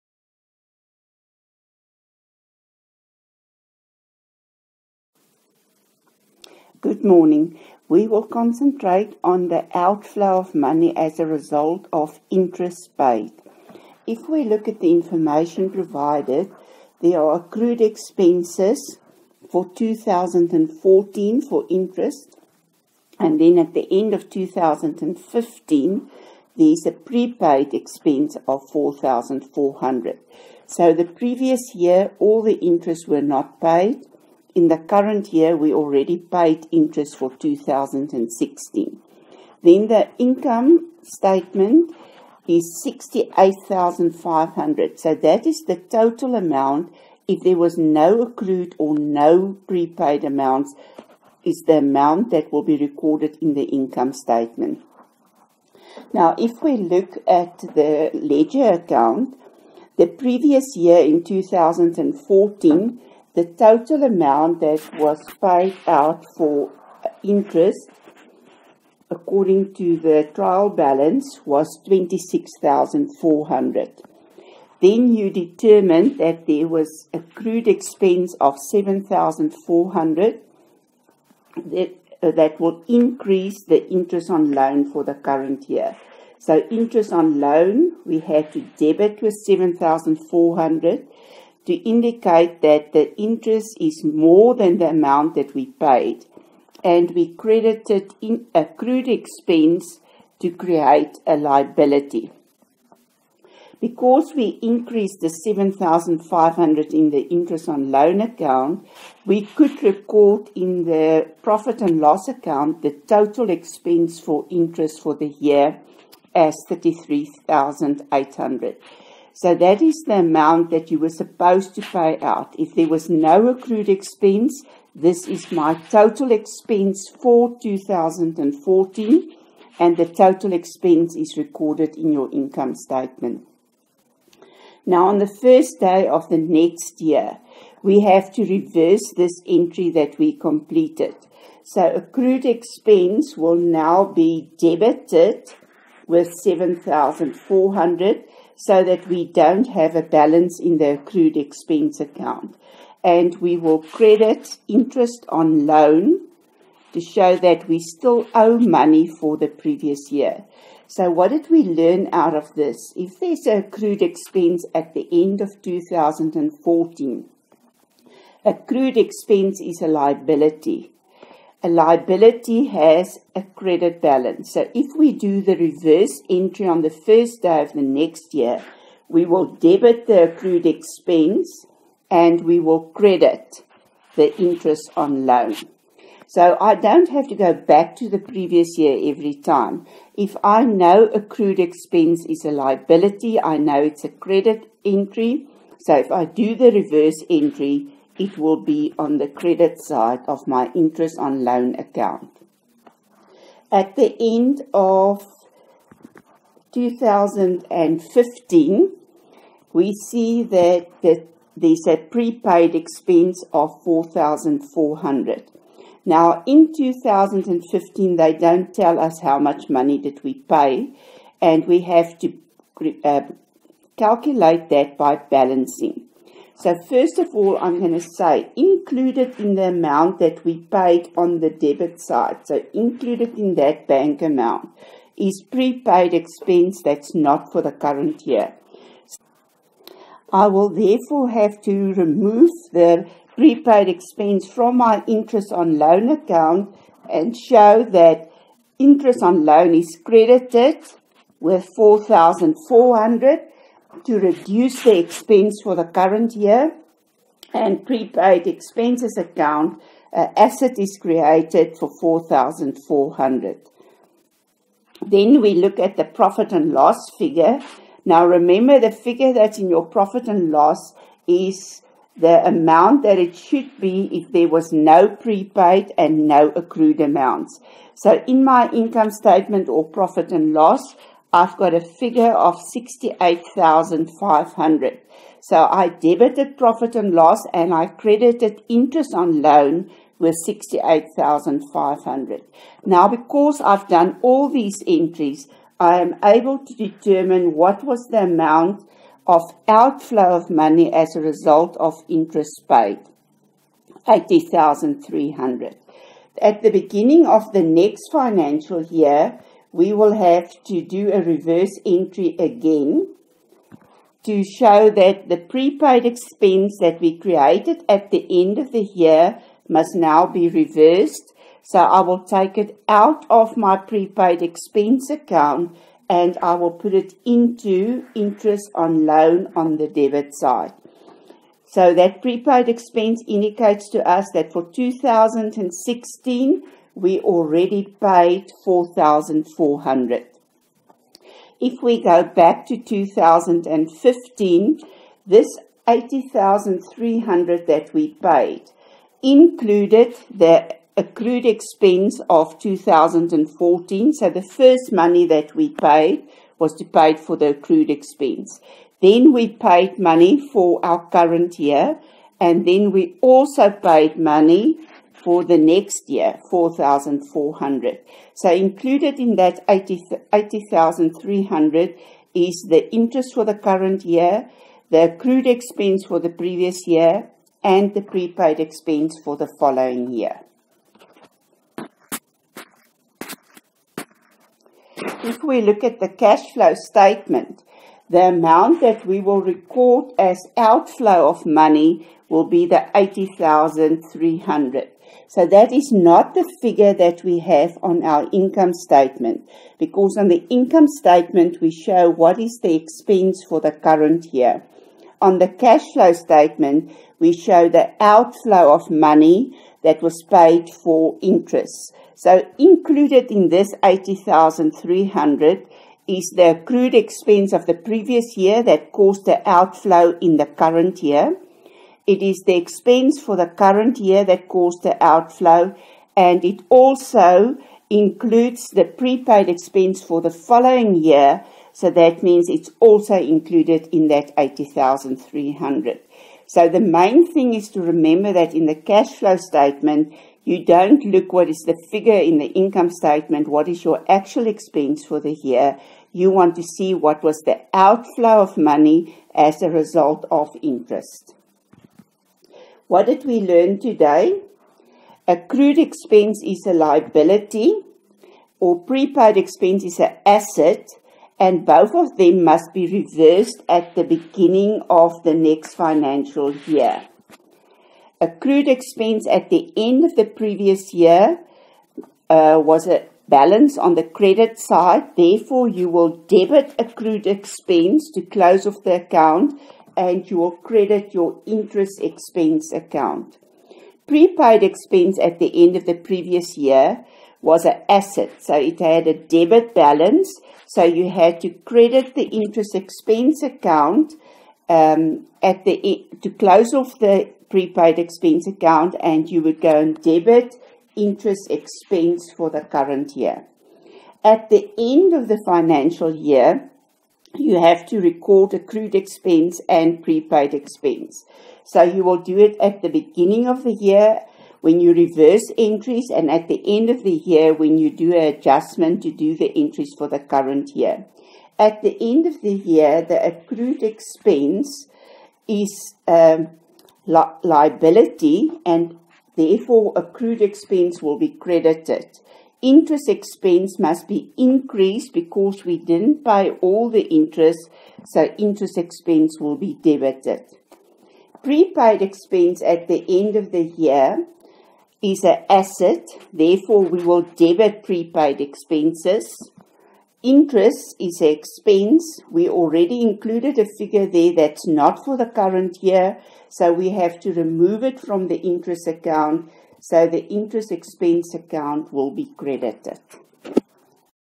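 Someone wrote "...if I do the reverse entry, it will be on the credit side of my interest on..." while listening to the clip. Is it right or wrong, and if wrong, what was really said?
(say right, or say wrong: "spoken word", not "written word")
right.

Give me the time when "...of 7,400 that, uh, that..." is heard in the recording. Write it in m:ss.
1:18.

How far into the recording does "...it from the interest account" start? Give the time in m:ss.
9:17.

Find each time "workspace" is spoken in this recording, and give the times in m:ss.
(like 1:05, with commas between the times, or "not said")
not said.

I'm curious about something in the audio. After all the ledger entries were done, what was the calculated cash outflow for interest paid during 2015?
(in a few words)
80,300.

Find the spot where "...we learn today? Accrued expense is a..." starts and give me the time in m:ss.
7:33.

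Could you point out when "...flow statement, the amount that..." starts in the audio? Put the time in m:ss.
6:26.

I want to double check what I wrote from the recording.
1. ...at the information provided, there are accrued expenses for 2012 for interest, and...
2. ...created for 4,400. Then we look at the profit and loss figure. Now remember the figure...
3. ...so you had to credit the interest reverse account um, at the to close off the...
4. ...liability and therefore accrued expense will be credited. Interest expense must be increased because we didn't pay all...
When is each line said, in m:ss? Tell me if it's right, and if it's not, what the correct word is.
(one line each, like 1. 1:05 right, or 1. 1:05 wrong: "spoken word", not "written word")
1. 0:14 wrong: "2014", not "2012"
2. 4:21 right
3. 8:10 wrong: "expense", not "reverse"
4. 8:47 right.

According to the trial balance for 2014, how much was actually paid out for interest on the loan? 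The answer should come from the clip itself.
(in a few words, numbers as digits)
26,400.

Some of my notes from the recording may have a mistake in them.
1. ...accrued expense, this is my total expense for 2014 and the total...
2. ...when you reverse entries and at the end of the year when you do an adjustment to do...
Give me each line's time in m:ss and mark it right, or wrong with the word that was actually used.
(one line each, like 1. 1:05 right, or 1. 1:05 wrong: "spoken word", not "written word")
1. 2:03 right
2. 8:34 right.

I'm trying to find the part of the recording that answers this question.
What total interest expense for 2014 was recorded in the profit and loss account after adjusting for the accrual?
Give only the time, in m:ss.
1:56.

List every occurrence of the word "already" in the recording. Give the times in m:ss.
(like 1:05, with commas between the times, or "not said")
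0:35, 5:37, 9:12.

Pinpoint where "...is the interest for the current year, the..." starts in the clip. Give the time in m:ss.
6:12.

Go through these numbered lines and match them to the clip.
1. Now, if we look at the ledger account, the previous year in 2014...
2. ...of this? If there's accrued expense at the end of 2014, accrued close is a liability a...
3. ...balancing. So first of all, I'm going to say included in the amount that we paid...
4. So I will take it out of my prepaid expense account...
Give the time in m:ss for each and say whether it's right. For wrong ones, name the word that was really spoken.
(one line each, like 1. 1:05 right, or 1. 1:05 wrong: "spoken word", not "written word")
1. 0:56 right
2. 2:42 wrong: "expense", not "close"
3. 3:45 right
4. 5:21 right.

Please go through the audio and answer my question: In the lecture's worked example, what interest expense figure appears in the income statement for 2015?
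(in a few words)
68,500.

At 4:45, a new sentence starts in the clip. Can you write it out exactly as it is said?
So I debited profit and loss and I credited interest on loan with 68,500.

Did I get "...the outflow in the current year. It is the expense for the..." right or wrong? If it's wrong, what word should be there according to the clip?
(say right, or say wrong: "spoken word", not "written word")
right.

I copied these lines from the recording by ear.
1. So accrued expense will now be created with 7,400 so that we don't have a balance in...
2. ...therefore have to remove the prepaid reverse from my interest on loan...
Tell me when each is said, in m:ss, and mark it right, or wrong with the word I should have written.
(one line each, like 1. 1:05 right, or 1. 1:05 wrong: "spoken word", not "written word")
1. 2:21 wrong: "debited", not "created"
2. 4:00 wrong: "expense", not "reverse".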